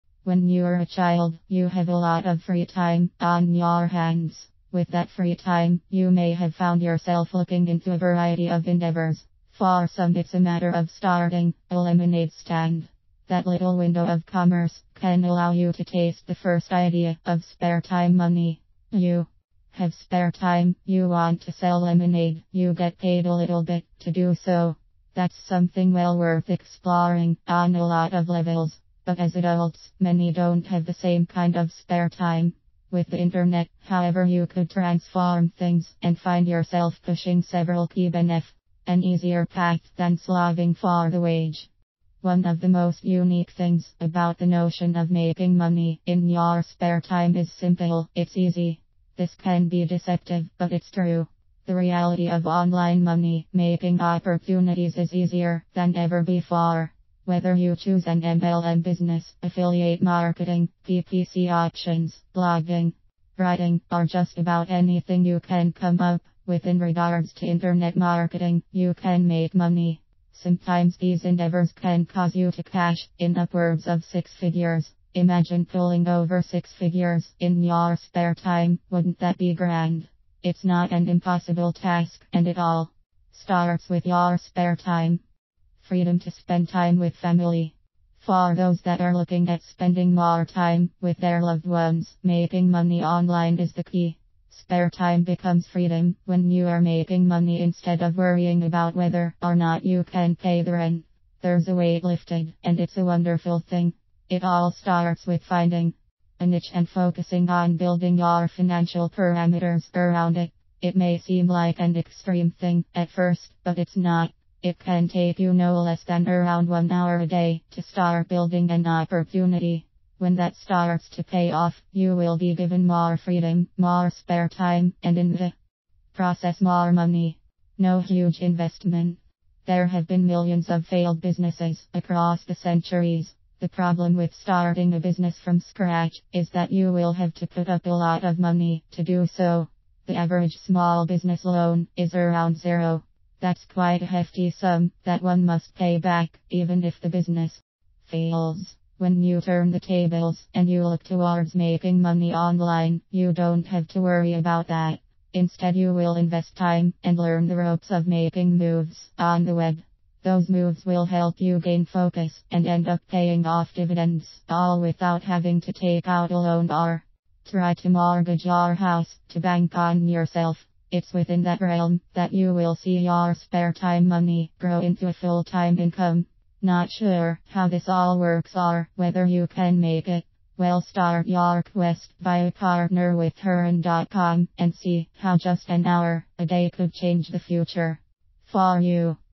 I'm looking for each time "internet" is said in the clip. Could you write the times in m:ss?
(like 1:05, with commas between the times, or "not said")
0:33, 1:07.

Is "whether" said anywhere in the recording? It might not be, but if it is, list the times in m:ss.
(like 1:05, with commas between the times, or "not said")
0:57, 1:38, 2:58.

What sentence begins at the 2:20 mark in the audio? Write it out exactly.
The average small business loan is around zero.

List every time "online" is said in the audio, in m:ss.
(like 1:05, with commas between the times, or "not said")
0:52, 1:33, 2:32.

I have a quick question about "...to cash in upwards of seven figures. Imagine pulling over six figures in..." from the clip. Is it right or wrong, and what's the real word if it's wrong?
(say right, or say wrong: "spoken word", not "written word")
wrong: "six", not "seven".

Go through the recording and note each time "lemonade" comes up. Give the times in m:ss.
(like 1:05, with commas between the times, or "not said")
0:11, 0:21.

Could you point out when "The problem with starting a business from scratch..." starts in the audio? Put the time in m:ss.
2:13.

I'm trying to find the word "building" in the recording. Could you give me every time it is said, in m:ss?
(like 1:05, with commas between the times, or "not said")
1:47, 1:58.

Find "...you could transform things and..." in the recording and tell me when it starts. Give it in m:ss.
0:34.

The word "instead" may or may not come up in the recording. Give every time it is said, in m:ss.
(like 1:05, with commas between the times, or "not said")
1:37, 2:35.